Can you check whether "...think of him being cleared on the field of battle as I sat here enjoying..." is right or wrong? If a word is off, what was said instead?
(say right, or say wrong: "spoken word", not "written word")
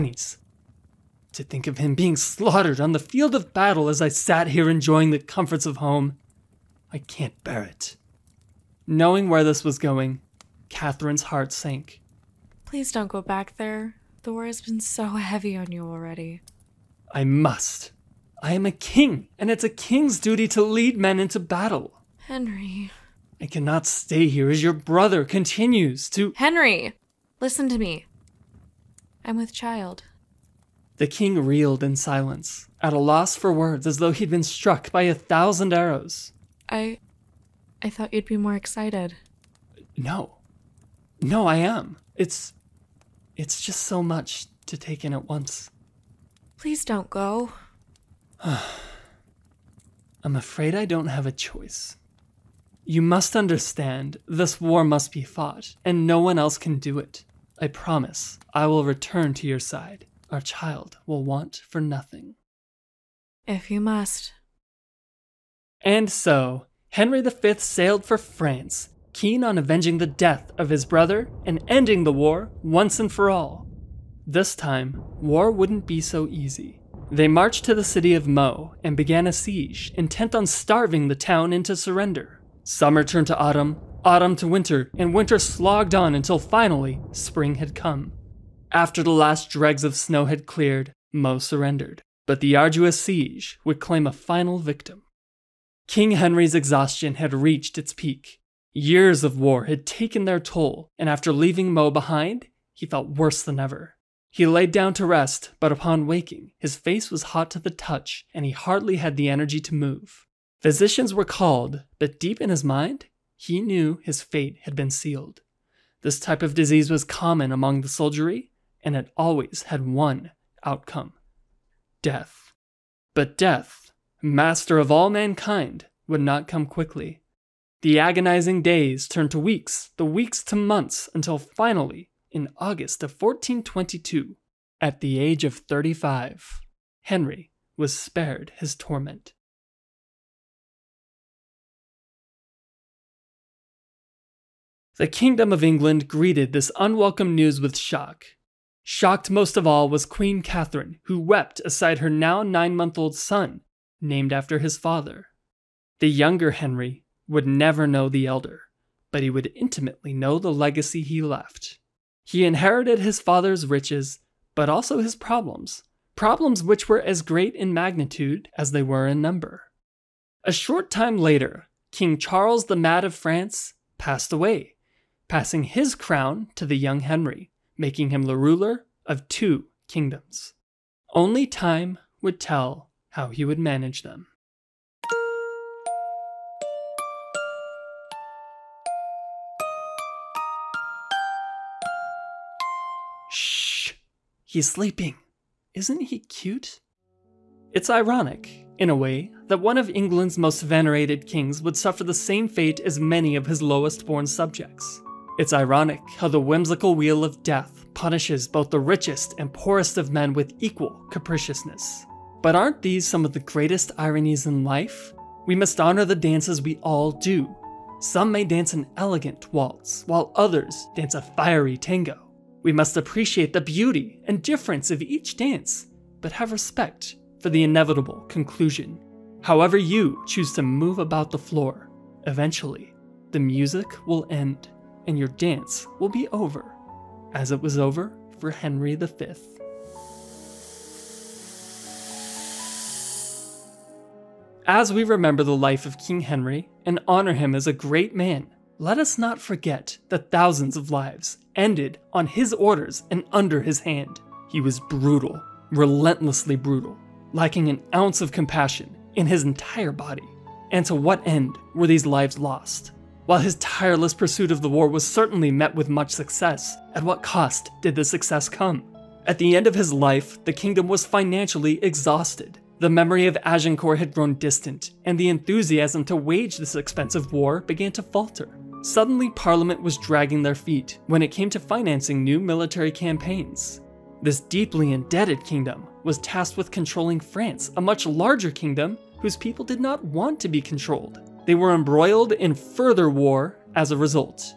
wrong: "slaughtered", not "cleared".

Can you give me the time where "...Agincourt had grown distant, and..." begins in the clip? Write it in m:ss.
4:33.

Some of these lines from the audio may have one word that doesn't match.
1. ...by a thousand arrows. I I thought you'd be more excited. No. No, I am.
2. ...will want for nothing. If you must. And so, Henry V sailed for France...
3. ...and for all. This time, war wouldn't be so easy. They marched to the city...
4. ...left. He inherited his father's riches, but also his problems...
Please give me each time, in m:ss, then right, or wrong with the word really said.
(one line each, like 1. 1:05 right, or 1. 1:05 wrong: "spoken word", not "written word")
1. 0:34 right
2. 1:01 right
3. 1:12 right
4. 2:41 right.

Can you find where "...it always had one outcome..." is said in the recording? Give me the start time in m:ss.
1:58.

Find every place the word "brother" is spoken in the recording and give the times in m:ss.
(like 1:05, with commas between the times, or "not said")
0:24, 1:10.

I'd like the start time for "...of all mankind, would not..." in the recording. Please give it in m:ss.
2:04.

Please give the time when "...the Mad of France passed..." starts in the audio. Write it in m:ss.
2:52.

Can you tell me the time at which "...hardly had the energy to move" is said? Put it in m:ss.
1:48.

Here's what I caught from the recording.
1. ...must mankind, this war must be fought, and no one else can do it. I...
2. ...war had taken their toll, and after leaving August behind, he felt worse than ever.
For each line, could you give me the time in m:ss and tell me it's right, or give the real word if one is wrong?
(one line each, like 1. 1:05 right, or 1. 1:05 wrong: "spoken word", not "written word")
1. 0:53 wrong: "understand", not "mankind"
2. 1:39 wrong: "Meaux", not "August".